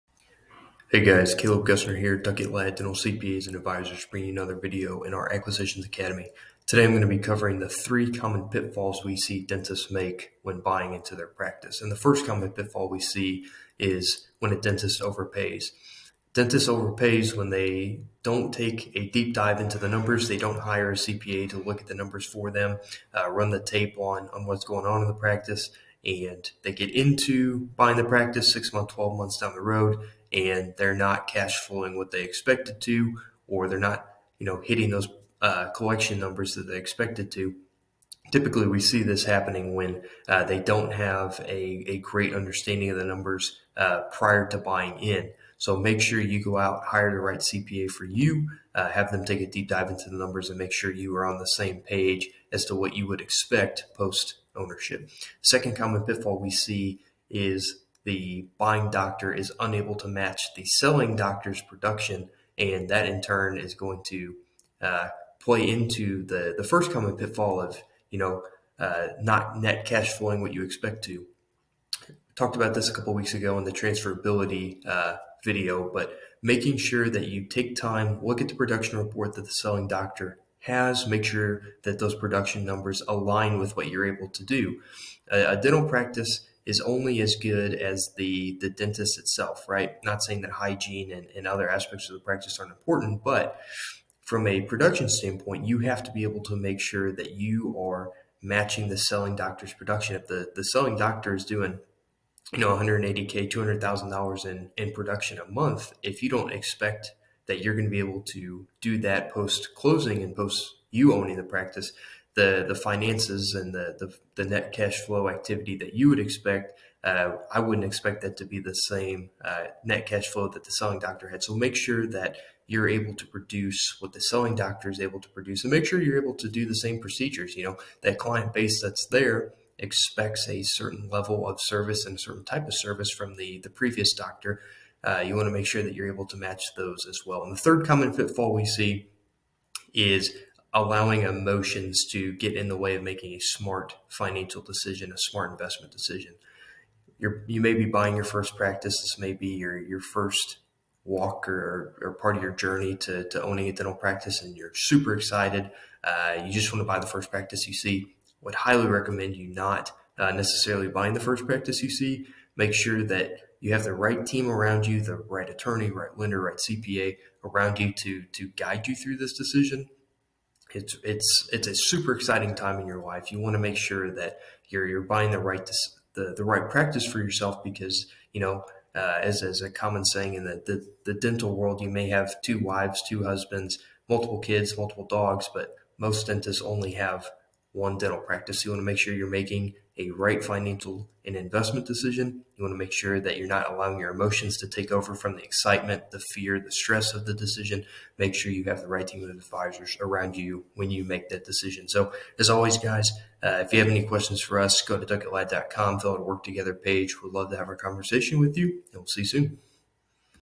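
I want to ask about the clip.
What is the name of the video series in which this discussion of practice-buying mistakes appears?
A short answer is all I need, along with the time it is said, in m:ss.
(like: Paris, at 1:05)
Acquisitions Academy, at 0:05.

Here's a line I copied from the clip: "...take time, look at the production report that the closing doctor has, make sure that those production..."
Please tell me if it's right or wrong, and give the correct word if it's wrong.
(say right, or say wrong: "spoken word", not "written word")
wrong: "selling", not "closing".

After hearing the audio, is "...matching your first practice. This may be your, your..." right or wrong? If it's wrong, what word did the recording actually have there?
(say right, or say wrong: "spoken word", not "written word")
wrong: "buying", not "matching".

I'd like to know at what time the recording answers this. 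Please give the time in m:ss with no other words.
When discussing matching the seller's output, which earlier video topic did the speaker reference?
1:13.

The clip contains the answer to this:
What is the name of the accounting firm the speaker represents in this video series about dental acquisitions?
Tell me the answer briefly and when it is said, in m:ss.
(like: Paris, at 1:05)
Duckett Ladd Dental CPAs and Advisors, at 0:02.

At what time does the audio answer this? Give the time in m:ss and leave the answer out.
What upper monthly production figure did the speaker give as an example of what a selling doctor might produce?
1:43.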